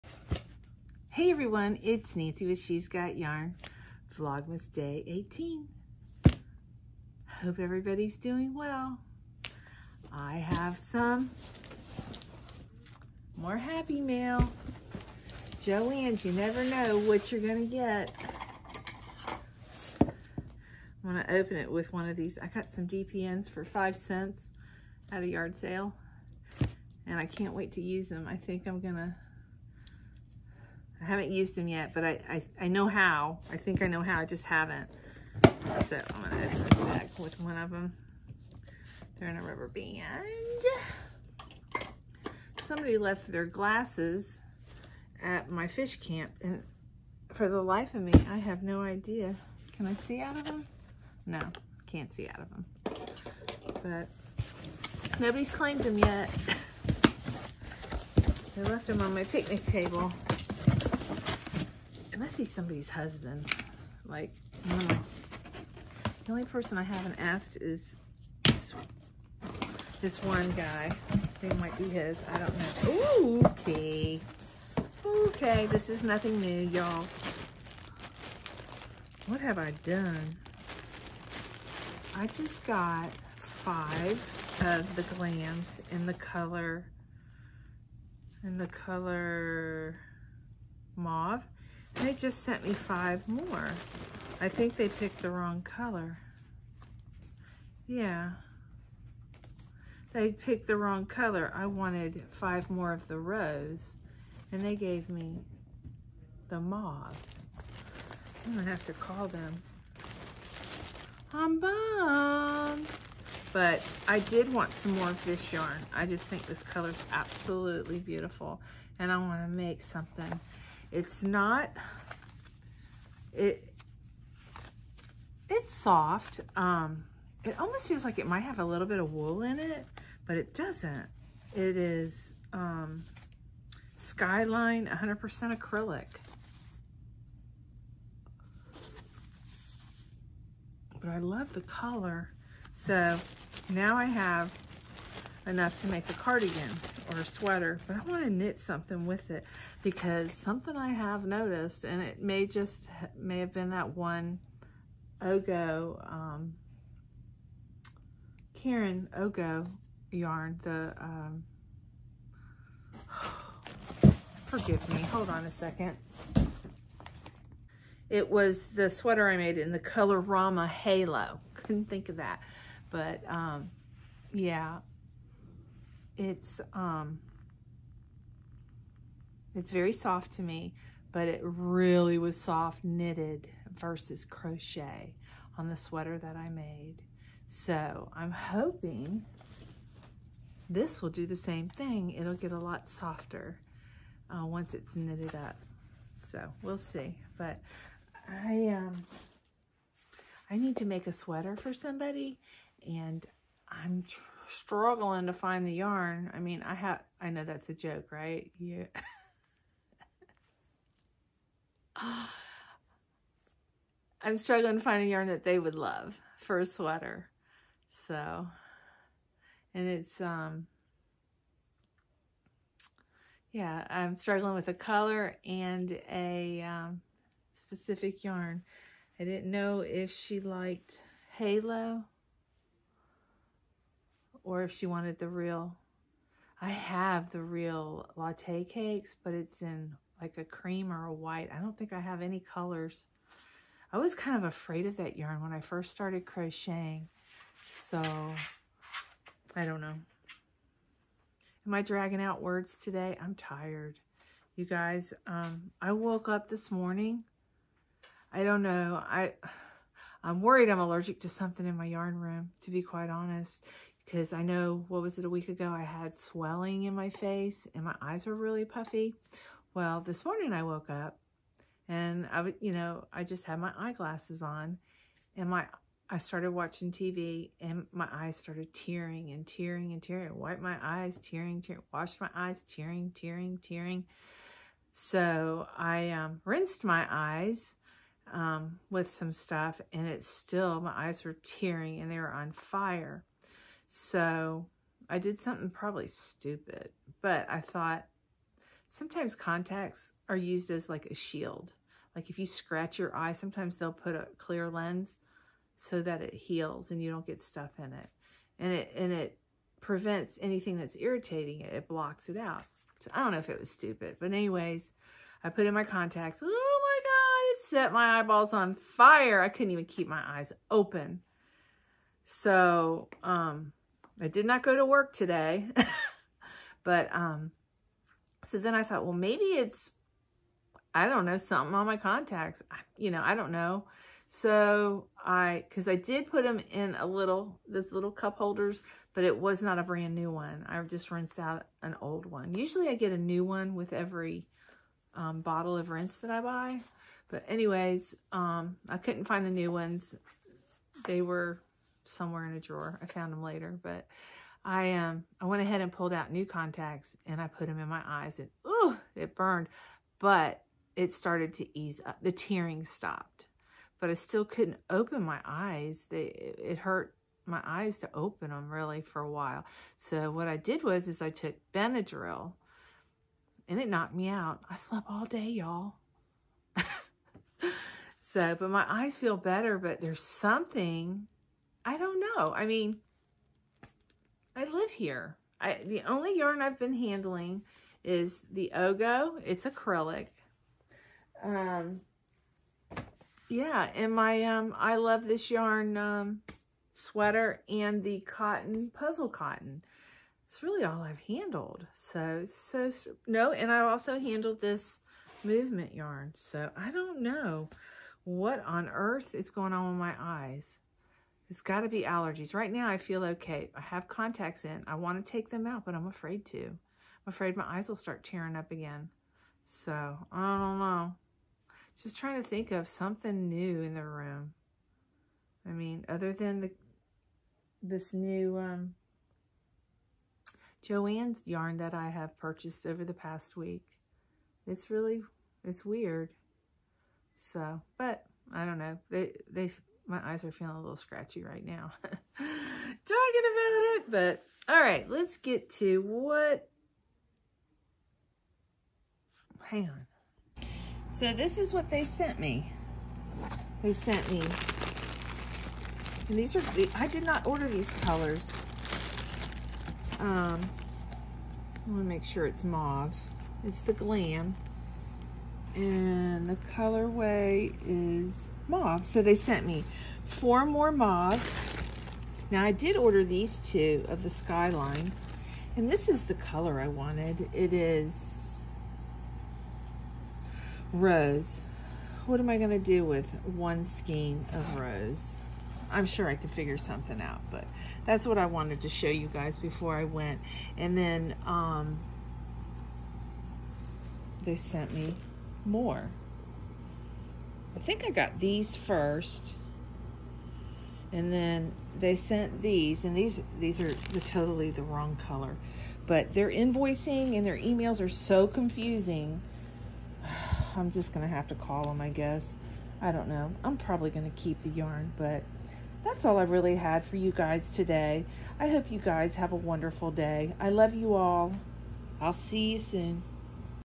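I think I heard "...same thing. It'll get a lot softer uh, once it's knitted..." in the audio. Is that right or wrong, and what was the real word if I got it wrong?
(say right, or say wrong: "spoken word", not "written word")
right.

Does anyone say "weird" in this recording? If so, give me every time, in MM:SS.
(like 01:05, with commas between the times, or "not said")
07:15.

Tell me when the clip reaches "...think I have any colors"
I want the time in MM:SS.
04:01.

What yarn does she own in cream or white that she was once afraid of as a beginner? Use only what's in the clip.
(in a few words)
latte cakes.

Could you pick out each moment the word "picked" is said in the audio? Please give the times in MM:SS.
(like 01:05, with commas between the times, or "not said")
01:34, 01:40.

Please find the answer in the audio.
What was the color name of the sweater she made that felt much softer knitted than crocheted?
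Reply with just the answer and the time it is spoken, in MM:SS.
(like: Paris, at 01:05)
Rama Halo, at 02:50.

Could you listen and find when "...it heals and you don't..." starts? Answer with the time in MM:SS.
05:06.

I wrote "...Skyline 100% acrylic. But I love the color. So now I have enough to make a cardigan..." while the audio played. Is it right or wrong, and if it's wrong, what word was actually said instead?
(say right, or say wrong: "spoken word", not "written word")
right.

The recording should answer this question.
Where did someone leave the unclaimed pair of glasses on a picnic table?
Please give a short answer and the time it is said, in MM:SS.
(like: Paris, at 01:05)
fish camp, at 00:45.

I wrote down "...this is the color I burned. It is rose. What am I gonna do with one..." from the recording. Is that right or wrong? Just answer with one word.
wrong.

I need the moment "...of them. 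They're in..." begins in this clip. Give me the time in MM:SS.
00:37.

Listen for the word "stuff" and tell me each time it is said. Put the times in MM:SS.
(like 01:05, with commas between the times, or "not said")
04:49, 05:07.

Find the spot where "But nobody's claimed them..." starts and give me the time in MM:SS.
00:54.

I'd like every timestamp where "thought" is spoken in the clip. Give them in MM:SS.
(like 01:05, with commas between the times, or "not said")
04:57, 05:28.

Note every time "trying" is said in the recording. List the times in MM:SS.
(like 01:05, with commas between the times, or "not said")
03:24, 07:02.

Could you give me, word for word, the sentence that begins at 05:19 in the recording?
I couldn't even keep my eyes open.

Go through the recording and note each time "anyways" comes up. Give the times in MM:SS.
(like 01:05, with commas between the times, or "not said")
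05:14, 05:47.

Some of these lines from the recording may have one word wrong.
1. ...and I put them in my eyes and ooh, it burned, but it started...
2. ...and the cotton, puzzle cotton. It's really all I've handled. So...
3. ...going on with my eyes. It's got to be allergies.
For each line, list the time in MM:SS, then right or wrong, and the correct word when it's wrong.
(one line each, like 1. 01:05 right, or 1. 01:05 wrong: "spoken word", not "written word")
1. 05:57 right
2. 06:37 right
3. 06:49 right.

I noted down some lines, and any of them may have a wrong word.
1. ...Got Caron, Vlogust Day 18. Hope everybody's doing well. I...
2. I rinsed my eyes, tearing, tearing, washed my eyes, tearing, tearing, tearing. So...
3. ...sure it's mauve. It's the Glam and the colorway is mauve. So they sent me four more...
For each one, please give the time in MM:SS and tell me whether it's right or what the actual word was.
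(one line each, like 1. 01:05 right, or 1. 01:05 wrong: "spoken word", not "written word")
1. 00:02 wrong: "Yarn", not "Caron"
2. 04:40 wrong: "wiped", not "rinsed"
3. 07:42 right.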